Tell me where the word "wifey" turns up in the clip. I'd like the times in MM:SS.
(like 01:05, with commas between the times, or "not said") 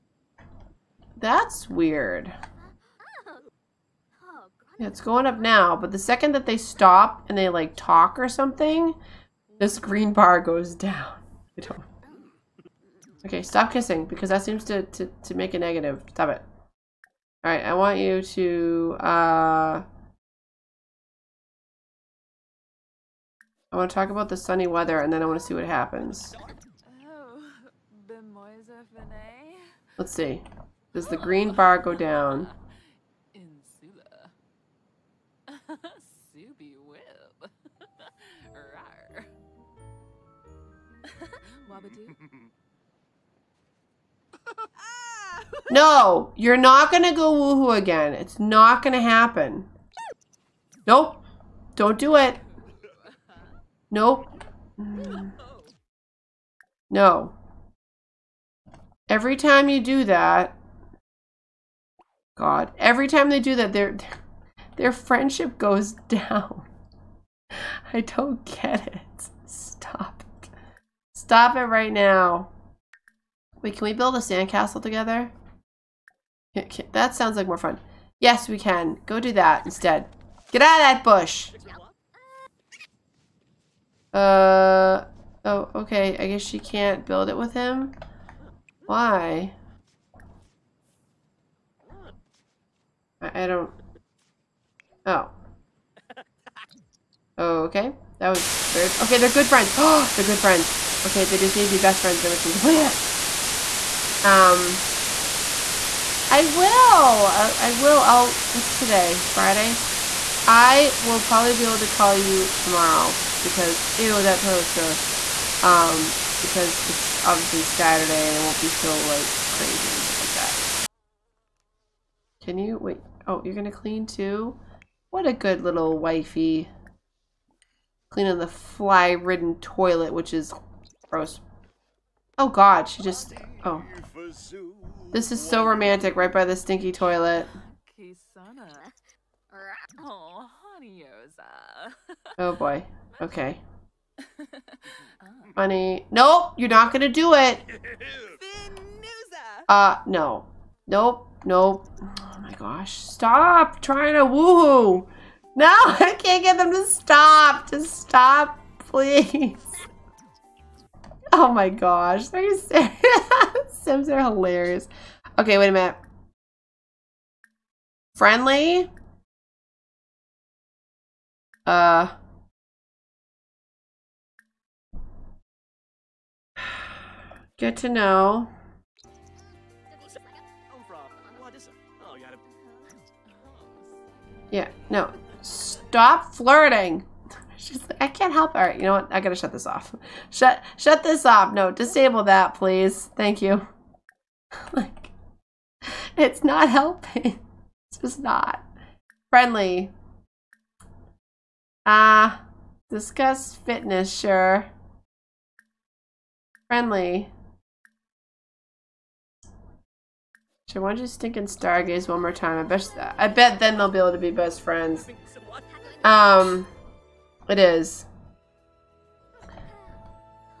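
02:05.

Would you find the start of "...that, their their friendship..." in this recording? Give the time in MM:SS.
01:03.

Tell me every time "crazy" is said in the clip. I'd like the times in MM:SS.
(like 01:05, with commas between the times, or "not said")
01:59.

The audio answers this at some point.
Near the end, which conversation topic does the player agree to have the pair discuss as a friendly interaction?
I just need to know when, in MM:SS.
03:22.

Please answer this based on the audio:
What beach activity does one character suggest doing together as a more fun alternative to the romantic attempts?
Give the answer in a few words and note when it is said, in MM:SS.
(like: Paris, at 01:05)
build a sandcastle, at 01:13.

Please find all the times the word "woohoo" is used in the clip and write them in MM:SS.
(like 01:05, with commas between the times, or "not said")
00:47, 02:34.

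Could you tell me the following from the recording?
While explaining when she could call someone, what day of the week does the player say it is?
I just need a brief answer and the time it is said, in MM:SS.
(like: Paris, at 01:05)
Friday, at 01:49.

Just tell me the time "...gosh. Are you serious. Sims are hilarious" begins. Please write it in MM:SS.
02:41.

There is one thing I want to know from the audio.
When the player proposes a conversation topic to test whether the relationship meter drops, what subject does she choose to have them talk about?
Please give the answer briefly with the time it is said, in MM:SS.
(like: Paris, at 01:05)
sunny weather, at 00:24.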